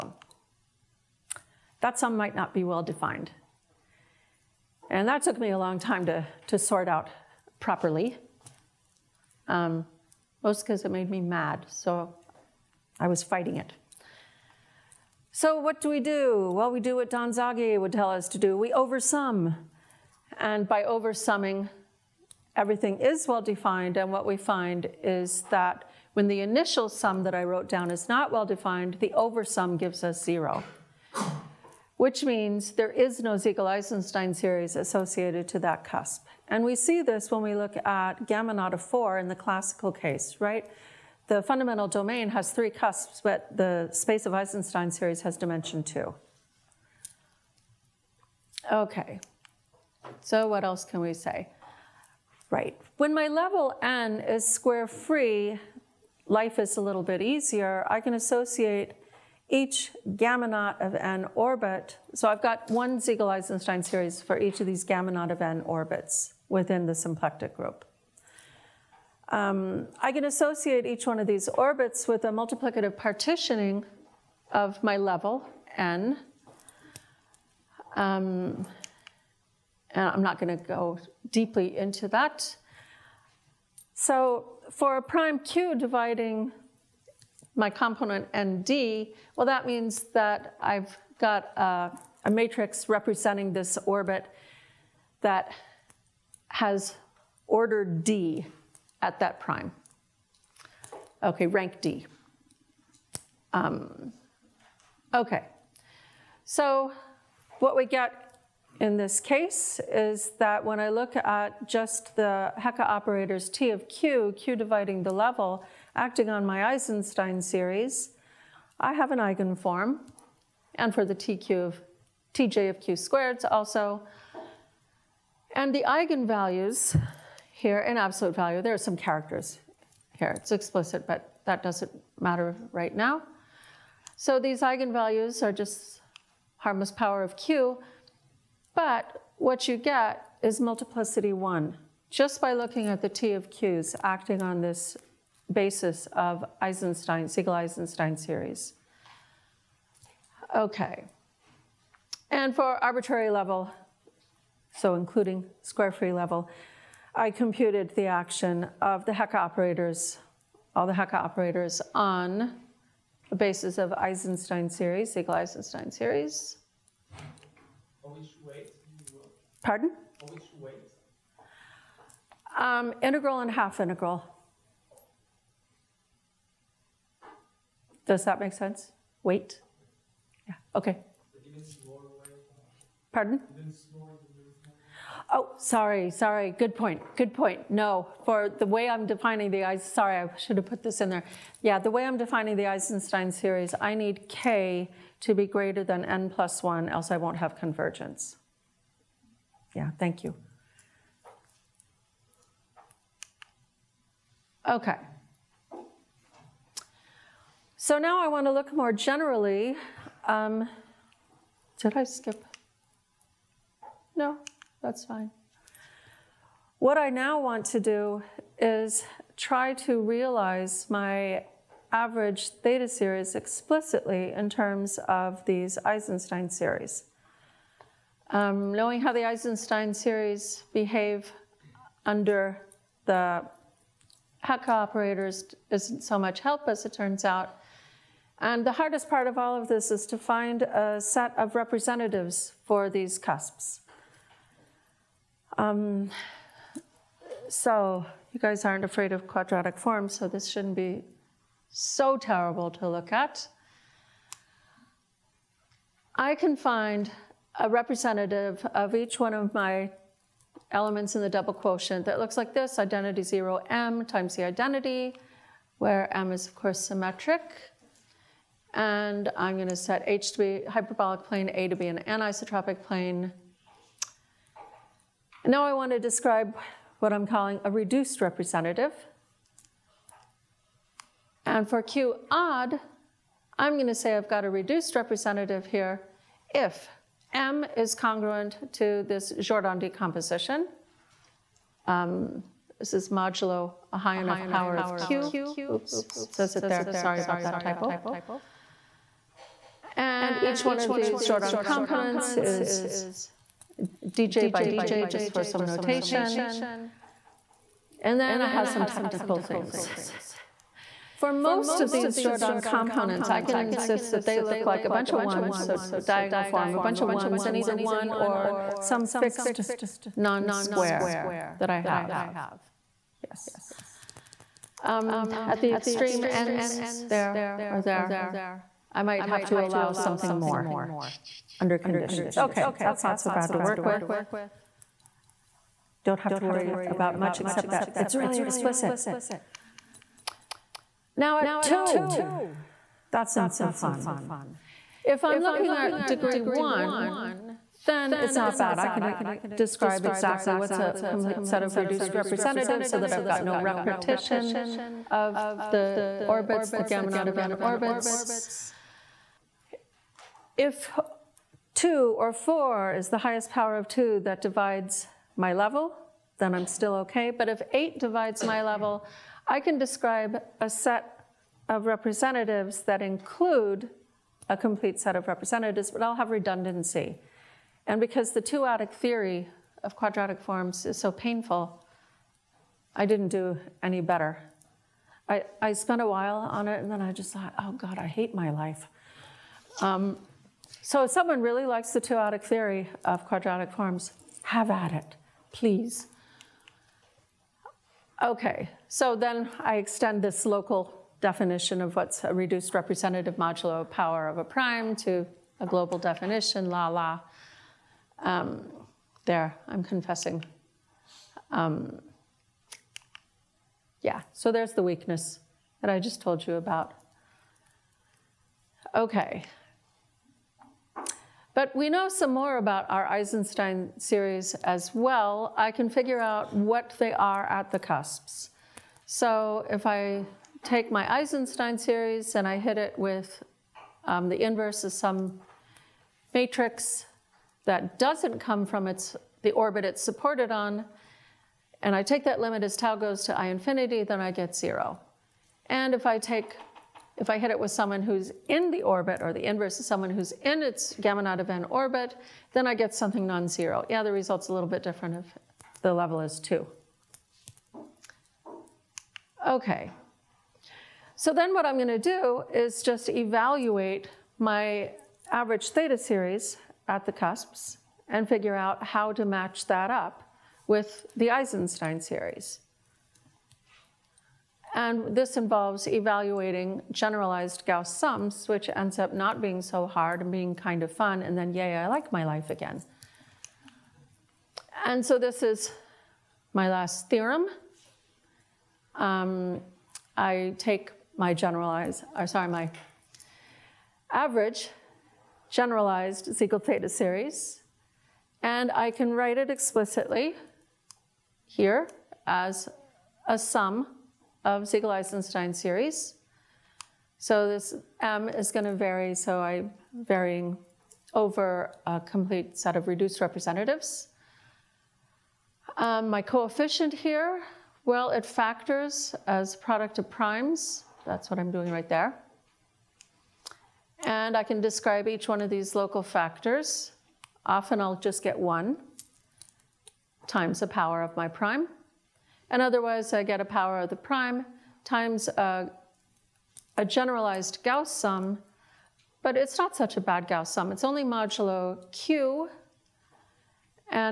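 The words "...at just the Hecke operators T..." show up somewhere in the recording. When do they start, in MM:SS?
01:51.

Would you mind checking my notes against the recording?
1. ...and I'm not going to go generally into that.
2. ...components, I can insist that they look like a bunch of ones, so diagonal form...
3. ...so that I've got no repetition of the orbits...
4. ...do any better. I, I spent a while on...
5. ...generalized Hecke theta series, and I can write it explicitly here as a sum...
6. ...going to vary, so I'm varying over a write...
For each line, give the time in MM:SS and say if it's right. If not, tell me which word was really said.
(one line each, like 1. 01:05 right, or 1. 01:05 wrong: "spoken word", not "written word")
1. 01:19 wrong: "deeply", not "generally"
2. 05:12 right
3. 05:52 right
4. 06:23 right
5. 08:15 wrong: "Siegel", not "Hecke"
6. 08:28 wrong: "complete", not "write".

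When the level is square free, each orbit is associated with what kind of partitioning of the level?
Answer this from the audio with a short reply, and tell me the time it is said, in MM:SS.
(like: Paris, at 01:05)
multiplicative partitioning, at 01:12.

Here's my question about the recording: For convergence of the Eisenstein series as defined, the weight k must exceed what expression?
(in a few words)
n plus 1.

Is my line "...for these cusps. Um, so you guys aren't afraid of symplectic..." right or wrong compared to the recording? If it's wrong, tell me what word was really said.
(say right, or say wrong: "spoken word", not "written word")
wrong: "quadratic", not "symplectic".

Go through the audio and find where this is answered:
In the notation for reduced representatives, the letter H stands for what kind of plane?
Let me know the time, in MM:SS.
04:30.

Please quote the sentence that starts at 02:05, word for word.
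And the eigenvalues here in absolute value, there are some characters here.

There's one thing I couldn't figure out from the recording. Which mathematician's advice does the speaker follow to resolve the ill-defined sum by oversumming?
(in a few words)
Don Zagier.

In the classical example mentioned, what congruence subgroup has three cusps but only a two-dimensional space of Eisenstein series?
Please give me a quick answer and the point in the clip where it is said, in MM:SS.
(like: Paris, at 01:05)
gamma naught of 4, at 00:38.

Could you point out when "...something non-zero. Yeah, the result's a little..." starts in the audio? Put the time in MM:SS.
07:32.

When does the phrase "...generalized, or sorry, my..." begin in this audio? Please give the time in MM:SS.
08:11.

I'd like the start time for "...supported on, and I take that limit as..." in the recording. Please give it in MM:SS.
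07:20.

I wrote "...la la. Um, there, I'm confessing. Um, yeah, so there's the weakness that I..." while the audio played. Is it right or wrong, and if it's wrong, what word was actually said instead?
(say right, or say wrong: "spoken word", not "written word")
right.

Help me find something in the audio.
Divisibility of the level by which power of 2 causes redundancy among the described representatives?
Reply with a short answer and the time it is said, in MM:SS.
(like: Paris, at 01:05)
8, at 06:07.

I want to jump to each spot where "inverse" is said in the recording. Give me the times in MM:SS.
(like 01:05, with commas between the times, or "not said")
07:14, 07:29.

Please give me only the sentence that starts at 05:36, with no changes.
Don't have to worry about much except that it's really explicit.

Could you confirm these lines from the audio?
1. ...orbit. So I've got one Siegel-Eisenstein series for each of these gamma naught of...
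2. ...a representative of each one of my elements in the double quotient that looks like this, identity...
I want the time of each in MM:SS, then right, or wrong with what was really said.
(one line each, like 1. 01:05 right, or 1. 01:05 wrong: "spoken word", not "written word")
1. 01:01 right
2. 04:17 right.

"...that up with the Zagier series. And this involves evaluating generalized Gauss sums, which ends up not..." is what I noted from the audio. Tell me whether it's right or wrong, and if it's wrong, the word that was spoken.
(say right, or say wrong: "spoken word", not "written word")
wrong: "Eisenstein", not "Zagier".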